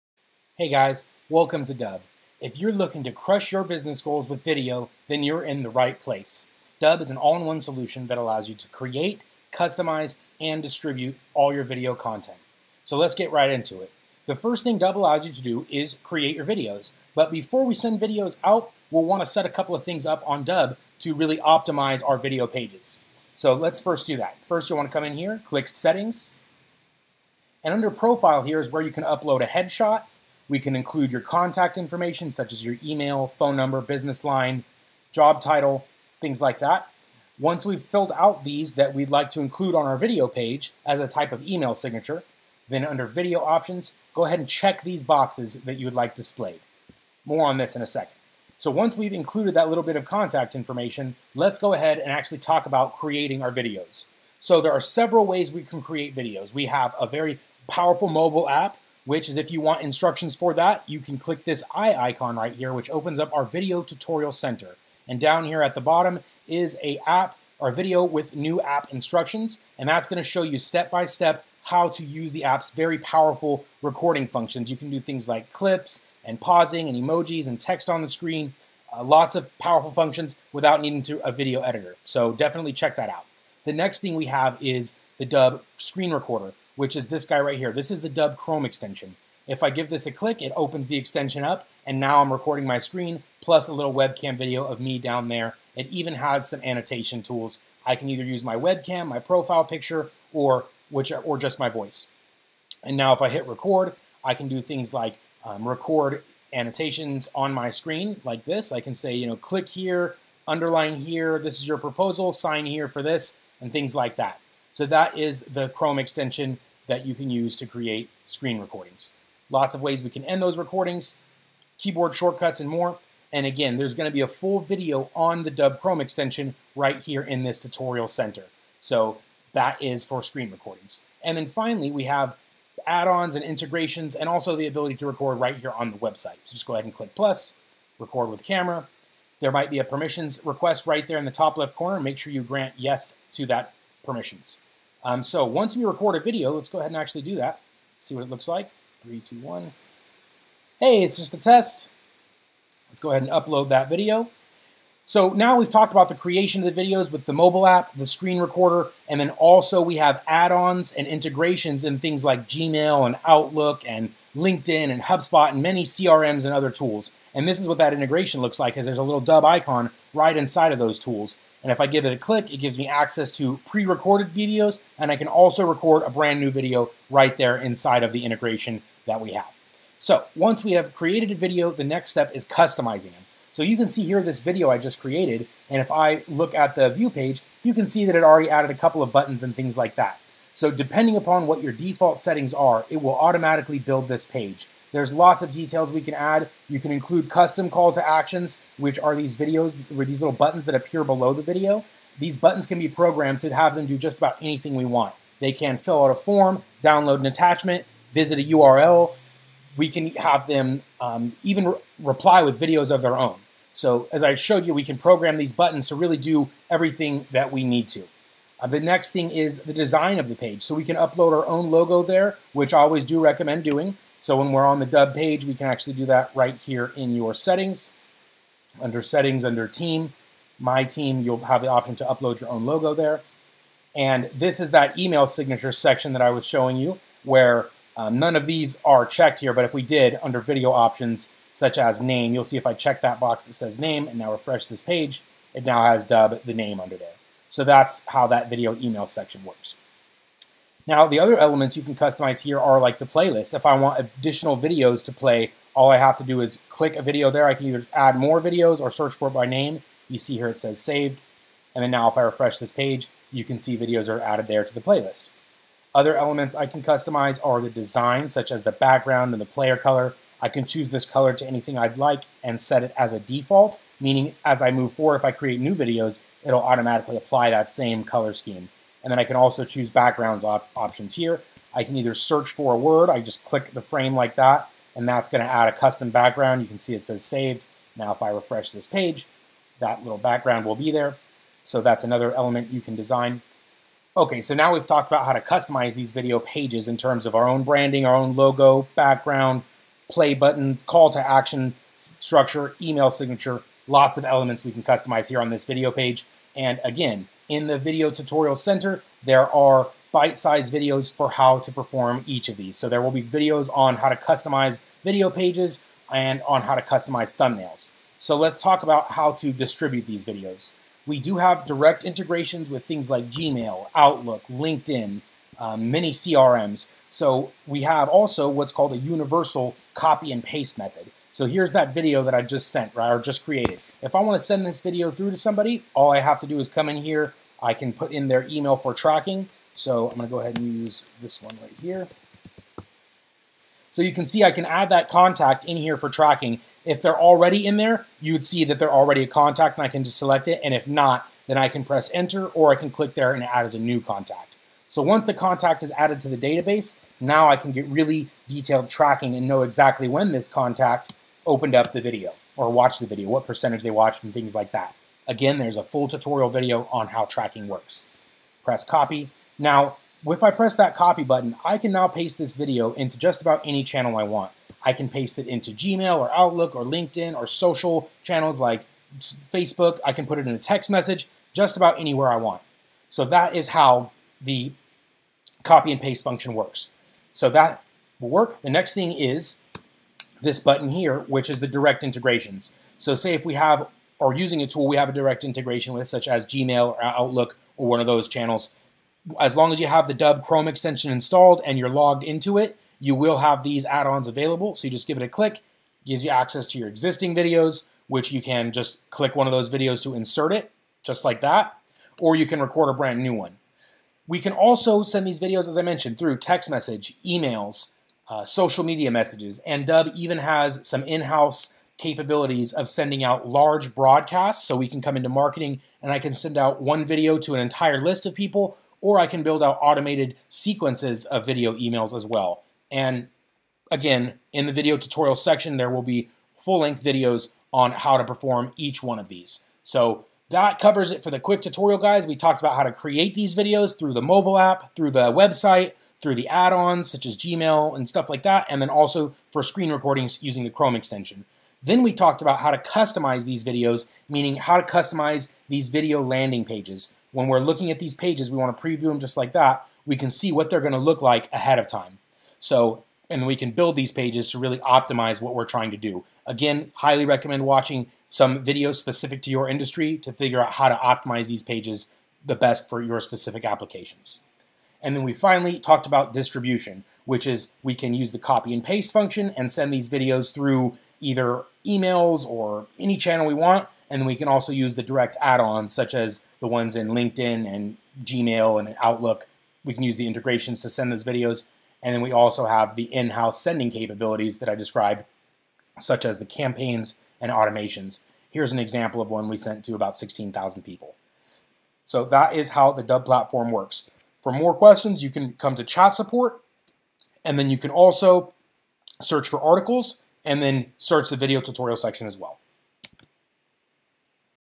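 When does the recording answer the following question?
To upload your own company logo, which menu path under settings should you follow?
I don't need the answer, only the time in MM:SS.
03:49.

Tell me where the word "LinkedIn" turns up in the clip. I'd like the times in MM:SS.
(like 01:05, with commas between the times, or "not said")
02:44, 05:24, 06:16, 08:07.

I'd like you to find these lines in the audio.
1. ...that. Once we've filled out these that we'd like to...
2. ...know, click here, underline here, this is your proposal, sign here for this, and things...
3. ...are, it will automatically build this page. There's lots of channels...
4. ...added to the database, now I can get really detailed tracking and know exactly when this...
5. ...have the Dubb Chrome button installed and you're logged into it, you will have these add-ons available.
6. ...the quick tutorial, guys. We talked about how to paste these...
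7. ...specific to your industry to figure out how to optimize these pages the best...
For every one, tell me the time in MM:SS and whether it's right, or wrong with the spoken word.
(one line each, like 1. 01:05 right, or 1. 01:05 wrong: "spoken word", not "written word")
1. 00:36 right
2. 01:49 right
3. 03:12 wrong: "details", not "channels"
4. 05:55 right
5. 06:39 wrong: "extension", not "button"
6. 07:21 wrong: "create", not "paste"
7. 07:48 right.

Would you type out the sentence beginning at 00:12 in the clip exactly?
So let's get right into it.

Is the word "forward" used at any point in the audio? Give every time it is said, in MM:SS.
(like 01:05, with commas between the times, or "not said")
04:34.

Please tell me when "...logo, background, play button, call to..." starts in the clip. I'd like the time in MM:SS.
04:58.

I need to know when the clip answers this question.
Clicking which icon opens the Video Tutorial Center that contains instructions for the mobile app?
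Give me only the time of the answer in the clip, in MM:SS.
01:01.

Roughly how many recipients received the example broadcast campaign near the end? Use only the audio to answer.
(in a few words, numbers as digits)
16,000.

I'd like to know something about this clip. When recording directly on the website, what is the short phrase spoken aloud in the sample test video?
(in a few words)
Hey, it's just a test.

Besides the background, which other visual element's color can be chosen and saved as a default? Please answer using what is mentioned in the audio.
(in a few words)
player color.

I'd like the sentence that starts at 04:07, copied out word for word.
So that's how that video email section works.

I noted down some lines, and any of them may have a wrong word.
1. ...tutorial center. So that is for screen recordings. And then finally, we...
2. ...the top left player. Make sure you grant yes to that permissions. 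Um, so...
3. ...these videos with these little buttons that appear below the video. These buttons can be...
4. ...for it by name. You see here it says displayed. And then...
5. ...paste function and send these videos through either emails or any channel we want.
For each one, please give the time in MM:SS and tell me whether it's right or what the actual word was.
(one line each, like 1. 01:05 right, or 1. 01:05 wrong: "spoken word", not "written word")
1. 02:07 right
2. 02:21 wrong: "corner", not "player"
3. 03:19 right
4. 04:19 wrong: "saved", not "displayed"
5. 07:58 right.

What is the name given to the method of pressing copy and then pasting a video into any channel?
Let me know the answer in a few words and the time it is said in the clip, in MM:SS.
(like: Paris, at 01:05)
universal copy and paste, at 05:28.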